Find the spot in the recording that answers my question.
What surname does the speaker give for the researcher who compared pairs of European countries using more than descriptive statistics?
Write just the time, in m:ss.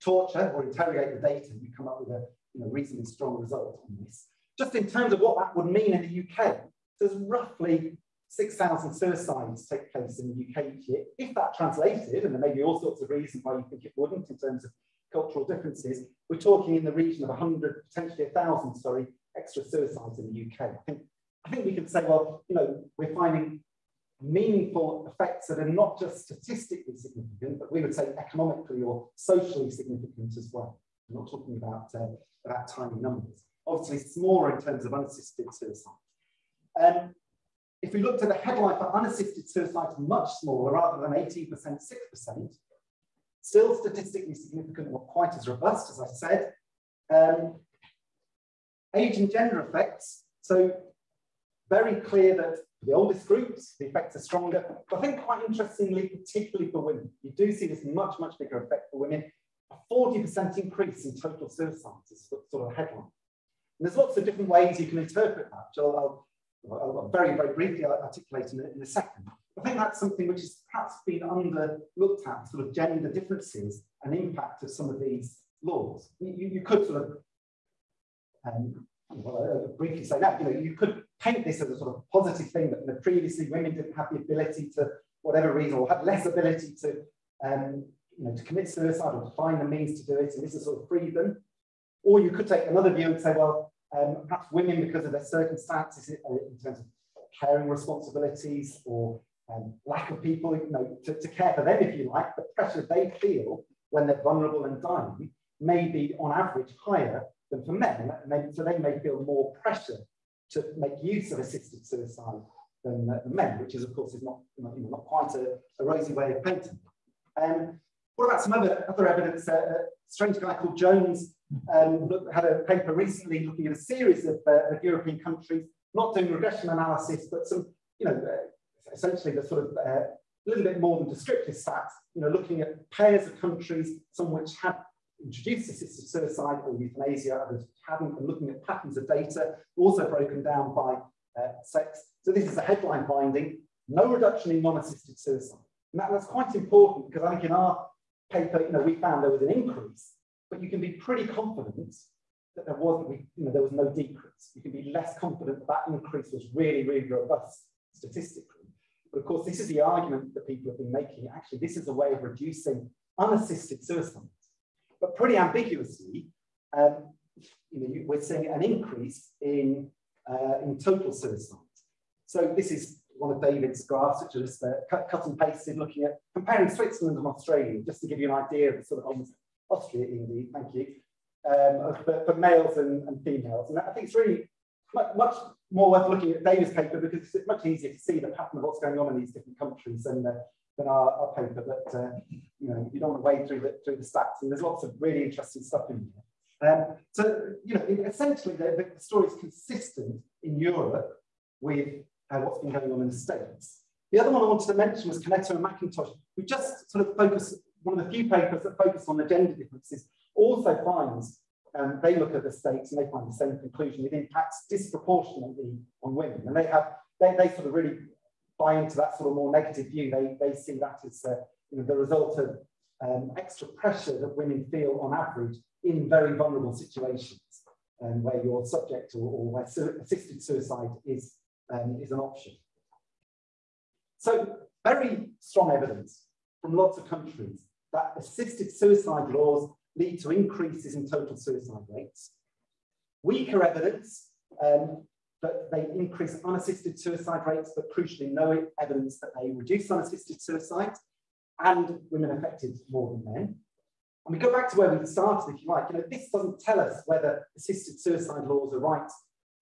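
2:00.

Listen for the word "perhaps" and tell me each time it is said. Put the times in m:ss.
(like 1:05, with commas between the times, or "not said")
1:10, 1:34.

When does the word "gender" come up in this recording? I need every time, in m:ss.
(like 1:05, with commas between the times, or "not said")
0:49, 1:12, 3:29.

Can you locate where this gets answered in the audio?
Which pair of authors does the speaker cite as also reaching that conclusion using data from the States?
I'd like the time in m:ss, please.
3:25.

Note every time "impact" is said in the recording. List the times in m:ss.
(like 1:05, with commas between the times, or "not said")
1:14, 3:34.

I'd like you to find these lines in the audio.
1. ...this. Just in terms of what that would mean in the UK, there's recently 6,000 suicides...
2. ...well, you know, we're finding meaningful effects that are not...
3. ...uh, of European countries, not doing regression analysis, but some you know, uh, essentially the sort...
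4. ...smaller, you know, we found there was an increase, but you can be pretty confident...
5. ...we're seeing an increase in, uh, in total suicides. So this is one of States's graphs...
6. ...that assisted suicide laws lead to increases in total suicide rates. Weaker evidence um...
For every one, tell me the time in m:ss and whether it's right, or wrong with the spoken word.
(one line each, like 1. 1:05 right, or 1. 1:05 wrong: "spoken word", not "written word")
1. 0:04 wrong: "roughly", not "recently"
2. 0:22 right
3. 2:04 right
4. 2:28 wrong: "paper", not "smaller"
5. 2:48 wrong: "David", not "States"
6. 3:57 right.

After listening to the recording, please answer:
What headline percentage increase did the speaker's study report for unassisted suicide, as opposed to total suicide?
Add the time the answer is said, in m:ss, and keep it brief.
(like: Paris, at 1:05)
6%, at 0:41.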